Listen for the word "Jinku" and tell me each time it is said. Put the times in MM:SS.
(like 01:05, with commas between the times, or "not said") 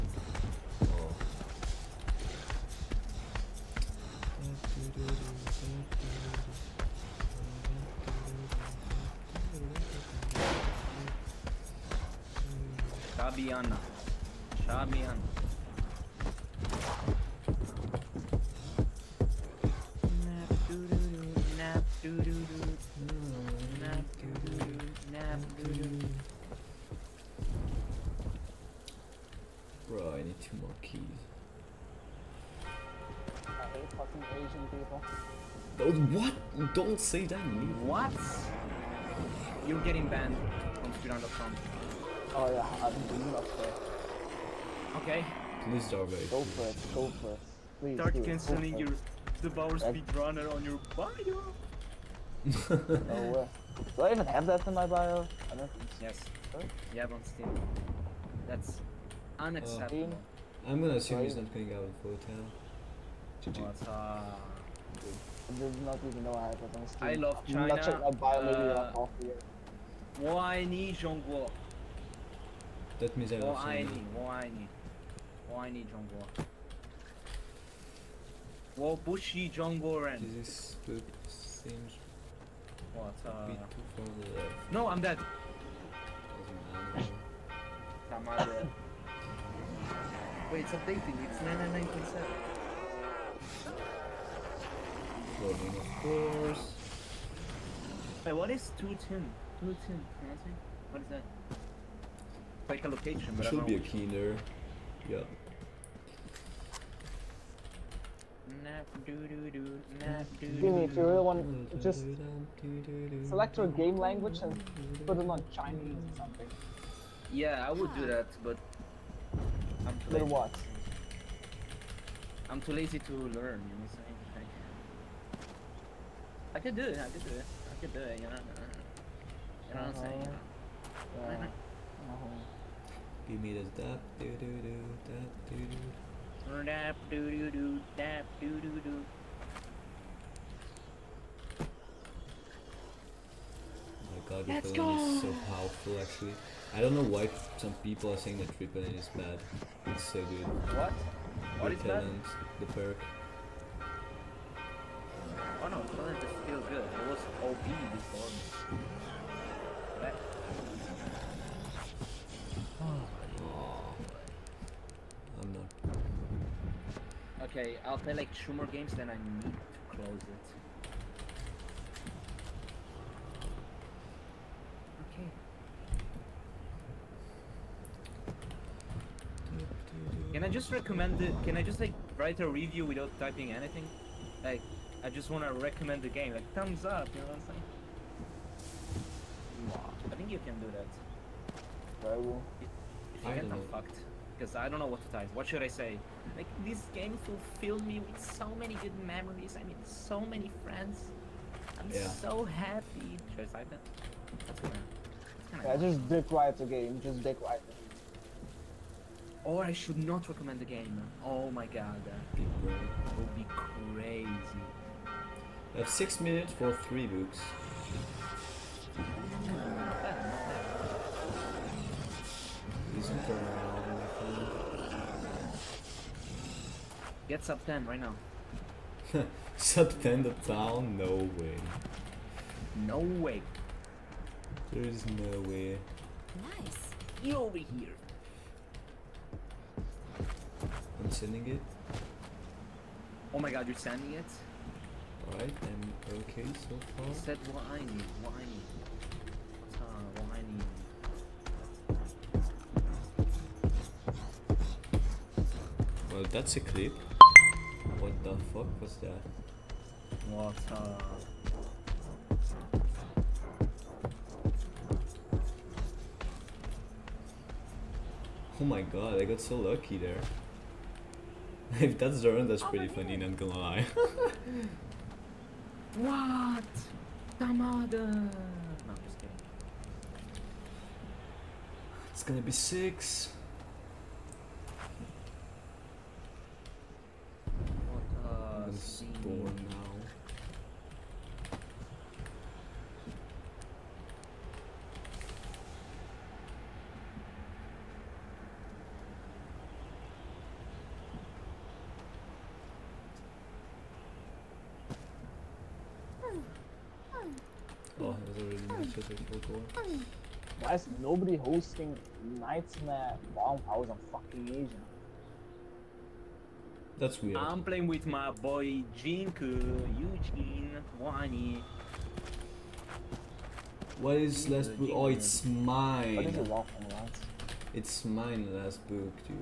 05:18.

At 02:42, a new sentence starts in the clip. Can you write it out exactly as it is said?
Oh, i Okay, I'll play like two more games, then I need to close it.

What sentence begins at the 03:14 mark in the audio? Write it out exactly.
Because I don't know what to type.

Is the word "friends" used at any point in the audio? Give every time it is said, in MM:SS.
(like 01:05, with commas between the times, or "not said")
03:20.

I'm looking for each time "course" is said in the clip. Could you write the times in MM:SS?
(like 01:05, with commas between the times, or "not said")
01:36.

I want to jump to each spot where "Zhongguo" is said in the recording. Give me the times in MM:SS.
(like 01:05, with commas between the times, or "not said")
01:10, 01:15.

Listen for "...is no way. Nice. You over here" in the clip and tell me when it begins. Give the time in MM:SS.
03:54.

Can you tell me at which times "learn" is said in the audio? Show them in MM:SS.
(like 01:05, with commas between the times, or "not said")
02:03.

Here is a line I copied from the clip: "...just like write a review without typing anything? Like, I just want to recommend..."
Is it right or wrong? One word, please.
right.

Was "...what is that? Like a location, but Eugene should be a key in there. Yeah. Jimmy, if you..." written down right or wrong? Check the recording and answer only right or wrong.
wrong.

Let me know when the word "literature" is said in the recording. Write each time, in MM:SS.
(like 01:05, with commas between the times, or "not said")
not said.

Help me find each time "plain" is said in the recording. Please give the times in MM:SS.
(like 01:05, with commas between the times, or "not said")
not said.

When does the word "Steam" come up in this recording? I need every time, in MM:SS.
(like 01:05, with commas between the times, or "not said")
00:57, 01:06.